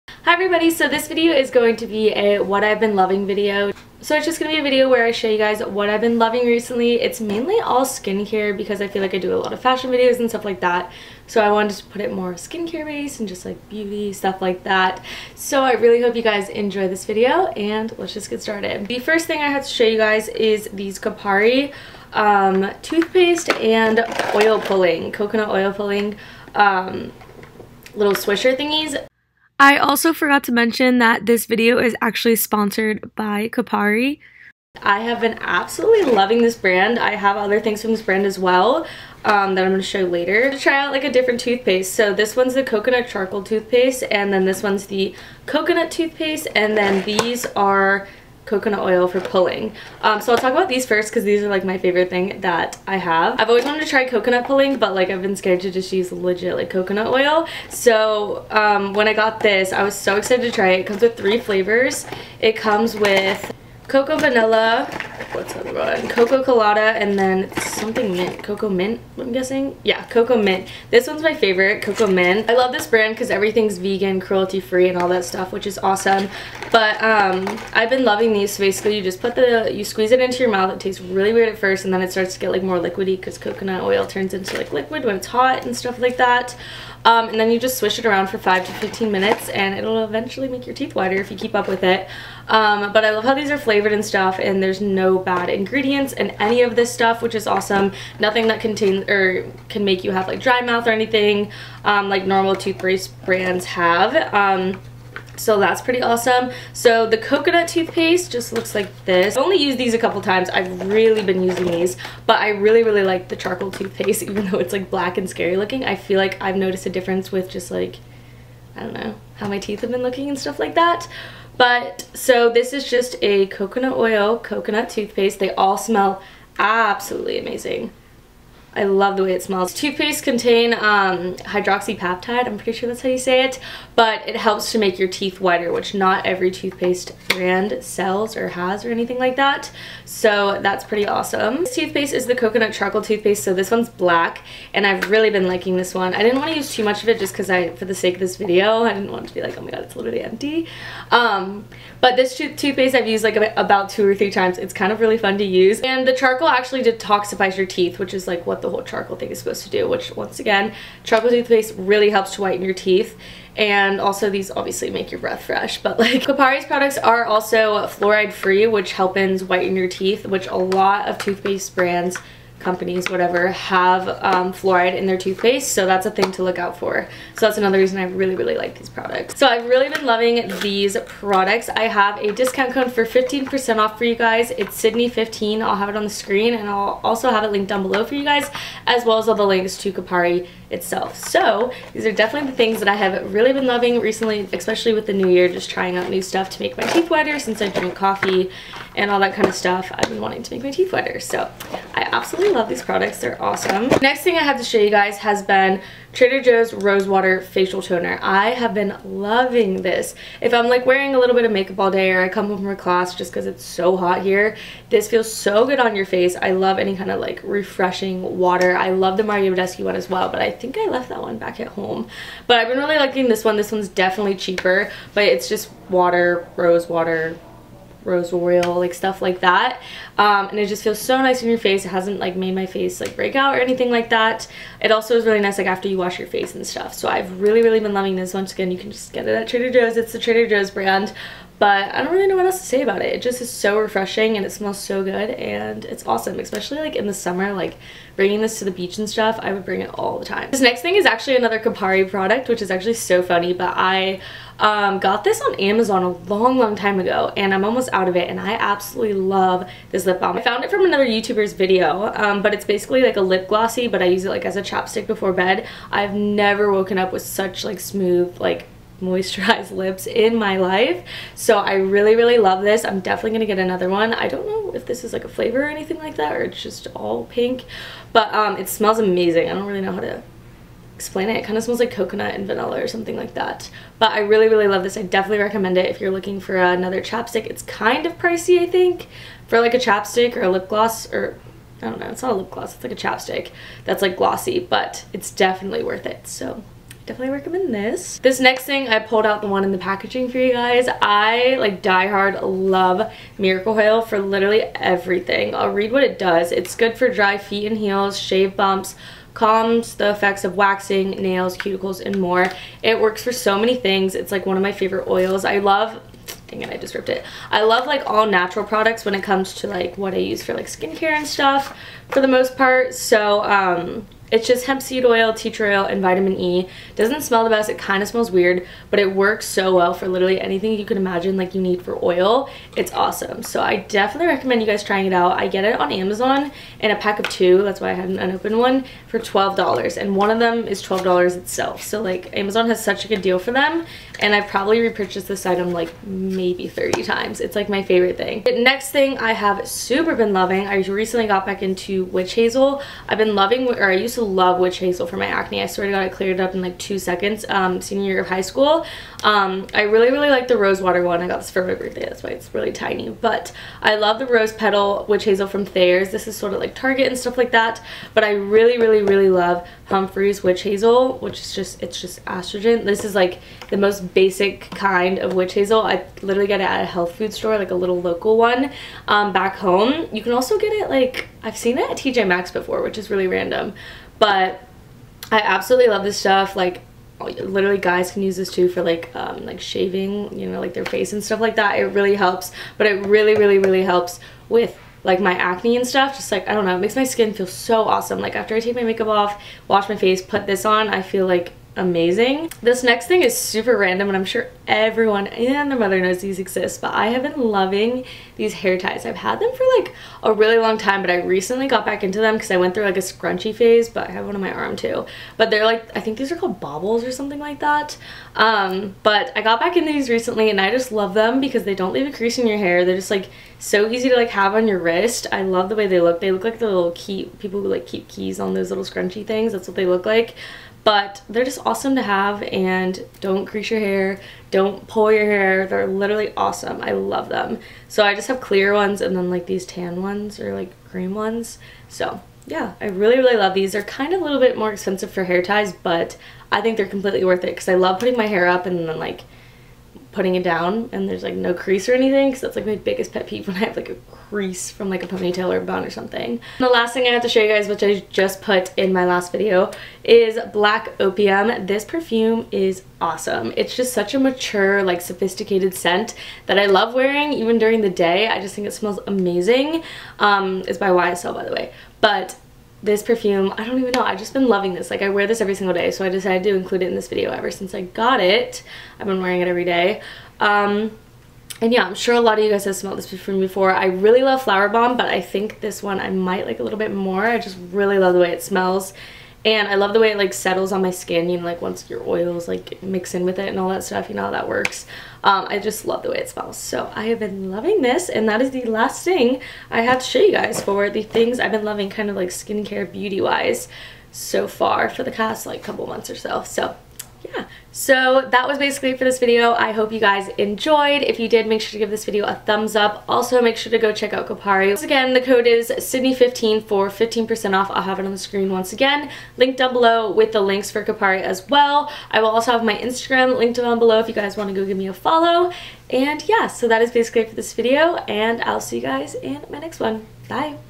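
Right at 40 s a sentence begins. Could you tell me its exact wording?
To try out like a different toothpaste.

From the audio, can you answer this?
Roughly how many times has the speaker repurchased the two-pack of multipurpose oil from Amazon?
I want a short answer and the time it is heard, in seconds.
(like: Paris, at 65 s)
30, at 346 s.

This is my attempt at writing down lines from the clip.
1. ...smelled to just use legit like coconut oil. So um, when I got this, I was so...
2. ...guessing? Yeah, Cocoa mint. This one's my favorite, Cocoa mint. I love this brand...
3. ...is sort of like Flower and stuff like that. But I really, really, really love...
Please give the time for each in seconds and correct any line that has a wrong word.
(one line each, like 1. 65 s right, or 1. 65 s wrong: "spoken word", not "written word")
1. 55 s wrong: "scared", not "smelled"
2. 69 s right
3. 366 s wrong: "Target", not "Flower".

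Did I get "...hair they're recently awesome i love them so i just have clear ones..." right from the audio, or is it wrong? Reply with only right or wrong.
wrong.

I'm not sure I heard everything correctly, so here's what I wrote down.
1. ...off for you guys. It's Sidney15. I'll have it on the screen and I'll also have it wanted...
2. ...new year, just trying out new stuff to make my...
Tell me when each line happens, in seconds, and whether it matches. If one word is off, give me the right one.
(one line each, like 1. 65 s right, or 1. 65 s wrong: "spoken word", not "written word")
1. 183 s wrong: "linked", not "wanted"
2. 195 s right.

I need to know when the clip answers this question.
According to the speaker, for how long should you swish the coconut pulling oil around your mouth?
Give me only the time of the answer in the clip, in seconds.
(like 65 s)
88 s.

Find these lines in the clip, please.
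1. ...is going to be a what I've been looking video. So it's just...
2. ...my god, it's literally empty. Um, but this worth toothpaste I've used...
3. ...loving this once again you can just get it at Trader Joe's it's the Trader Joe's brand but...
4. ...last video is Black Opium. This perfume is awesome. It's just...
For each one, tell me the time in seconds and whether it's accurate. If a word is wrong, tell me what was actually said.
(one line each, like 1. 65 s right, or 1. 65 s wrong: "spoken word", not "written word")
1. 1 s wrong: "loving", not "looking"
2. 149 s wrong: "tooth", not "worth"
3. 237 s right
4. 459 s right.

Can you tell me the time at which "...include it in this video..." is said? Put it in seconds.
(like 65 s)
476 s.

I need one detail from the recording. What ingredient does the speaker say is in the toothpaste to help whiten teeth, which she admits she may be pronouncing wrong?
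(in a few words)
hydroxypeptide.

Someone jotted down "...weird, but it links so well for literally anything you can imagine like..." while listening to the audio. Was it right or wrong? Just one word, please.
wrong.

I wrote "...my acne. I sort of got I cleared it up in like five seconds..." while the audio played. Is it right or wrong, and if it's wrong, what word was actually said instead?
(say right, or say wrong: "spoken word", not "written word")
wrong: "two", not "five".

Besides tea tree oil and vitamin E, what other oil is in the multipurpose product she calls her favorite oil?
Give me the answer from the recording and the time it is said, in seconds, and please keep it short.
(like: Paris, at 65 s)
hemp seed oil, at 324 s.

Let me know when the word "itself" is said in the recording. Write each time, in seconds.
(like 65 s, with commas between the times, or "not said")
190 s, 341 s.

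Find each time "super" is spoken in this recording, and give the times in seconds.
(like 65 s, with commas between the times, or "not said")
349 s, 403 s.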